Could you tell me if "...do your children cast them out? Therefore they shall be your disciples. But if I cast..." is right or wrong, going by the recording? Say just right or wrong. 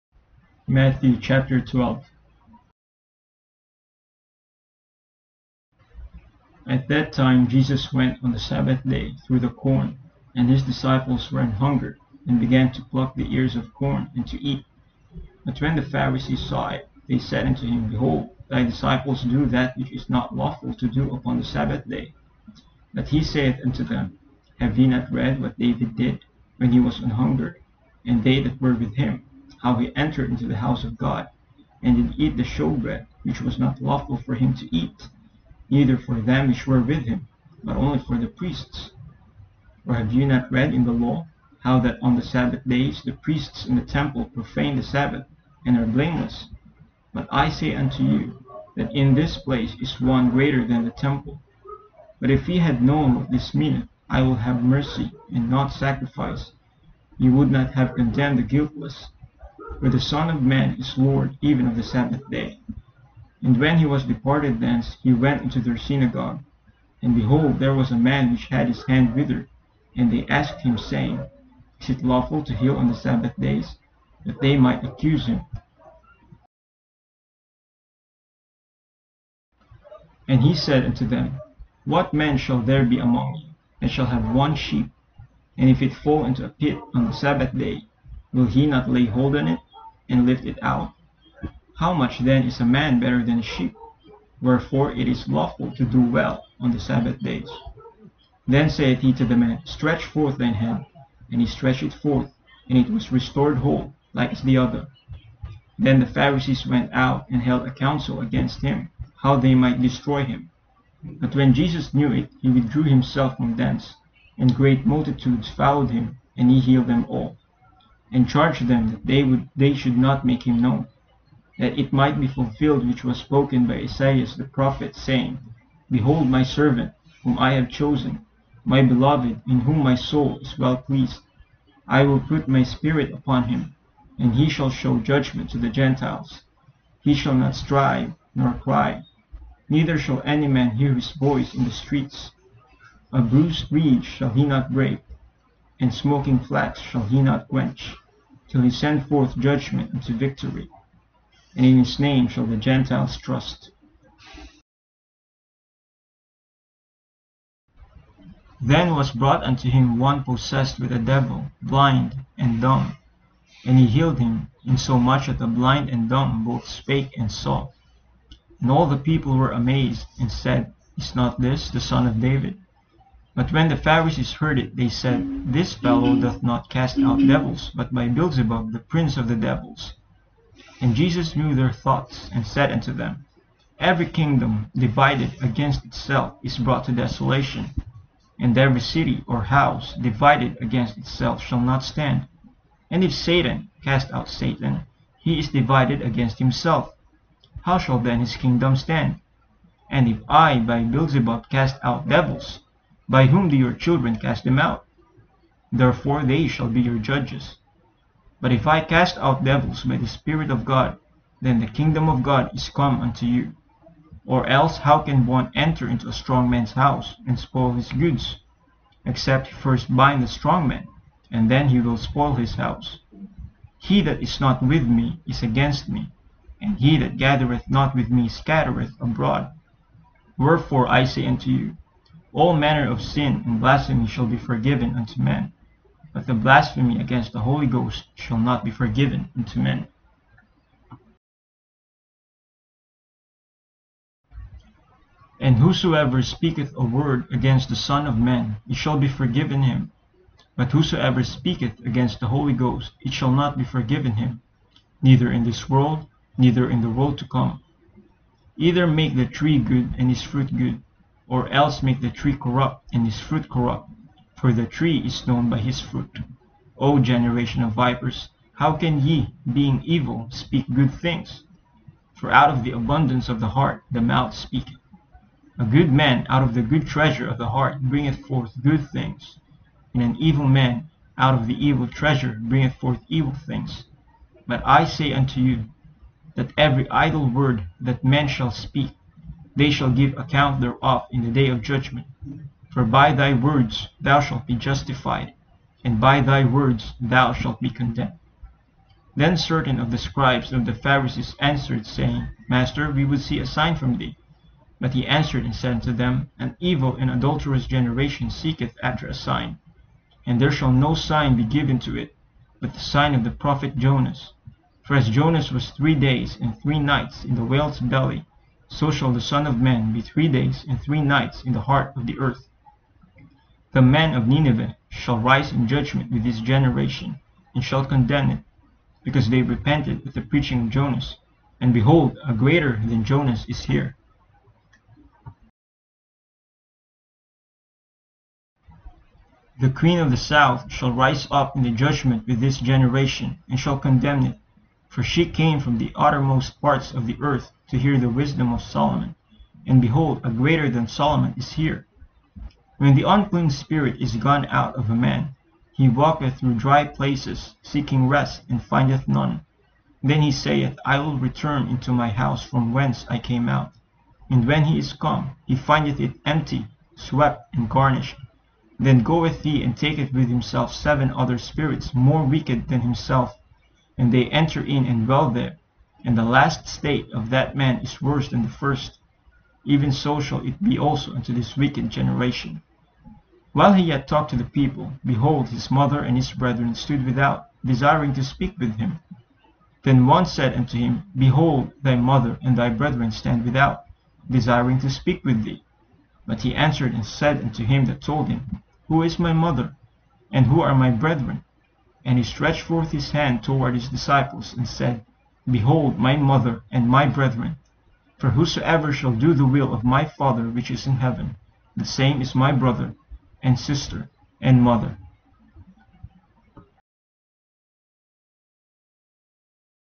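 wrong.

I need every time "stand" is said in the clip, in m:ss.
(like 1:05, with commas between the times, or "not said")
3:11, 3:18, 6:33.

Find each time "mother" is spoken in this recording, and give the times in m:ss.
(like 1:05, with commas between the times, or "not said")
6:25, 6:31, 6:39, 6:46, 6:54.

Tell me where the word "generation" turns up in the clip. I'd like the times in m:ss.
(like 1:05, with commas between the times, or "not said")
4:26, 5:07, 5:26, 5:42, 6:21.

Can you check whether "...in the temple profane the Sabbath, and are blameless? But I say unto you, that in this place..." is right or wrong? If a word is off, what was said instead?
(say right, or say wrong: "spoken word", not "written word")
right.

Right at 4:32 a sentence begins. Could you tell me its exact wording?
For out of the abundance of the heart the mouth speaketh.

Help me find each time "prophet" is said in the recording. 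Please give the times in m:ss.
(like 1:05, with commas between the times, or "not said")
2:04, 5:13.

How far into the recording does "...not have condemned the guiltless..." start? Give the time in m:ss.
0:57.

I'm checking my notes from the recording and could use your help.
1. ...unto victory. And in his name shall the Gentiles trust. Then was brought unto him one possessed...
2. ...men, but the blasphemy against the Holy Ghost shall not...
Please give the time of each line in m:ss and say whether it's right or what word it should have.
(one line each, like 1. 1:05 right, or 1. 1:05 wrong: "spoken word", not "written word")
1. 2:29 right
2. 3:55 right.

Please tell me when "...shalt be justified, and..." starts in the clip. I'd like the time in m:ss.
4:54.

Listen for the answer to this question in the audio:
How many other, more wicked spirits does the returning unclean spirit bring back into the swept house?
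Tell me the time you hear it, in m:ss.
6:10.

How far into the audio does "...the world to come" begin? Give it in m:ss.
4:16.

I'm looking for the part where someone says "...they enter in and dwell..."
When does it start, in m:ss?
6:14.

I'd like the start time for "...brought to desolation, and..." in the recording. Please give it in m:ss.
3:06.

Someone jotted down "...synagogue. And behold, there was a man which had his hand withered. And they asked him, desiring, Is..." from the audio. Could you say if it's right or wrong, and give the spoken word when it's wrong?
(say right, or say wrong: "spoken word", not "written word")
wrong: "saying", not "desiring".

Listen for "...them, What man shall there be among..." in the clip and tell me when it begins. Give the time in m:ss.
1:21.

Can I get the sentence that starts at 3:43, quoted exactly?
He that is not with me is against me, and he that gathereth not with me scattereth abroad.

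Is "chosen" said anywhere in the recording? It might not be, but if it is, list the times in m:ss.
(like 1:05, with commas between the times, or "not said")
2:07.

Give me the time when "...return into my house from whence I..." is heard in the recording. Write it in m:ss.
6:01.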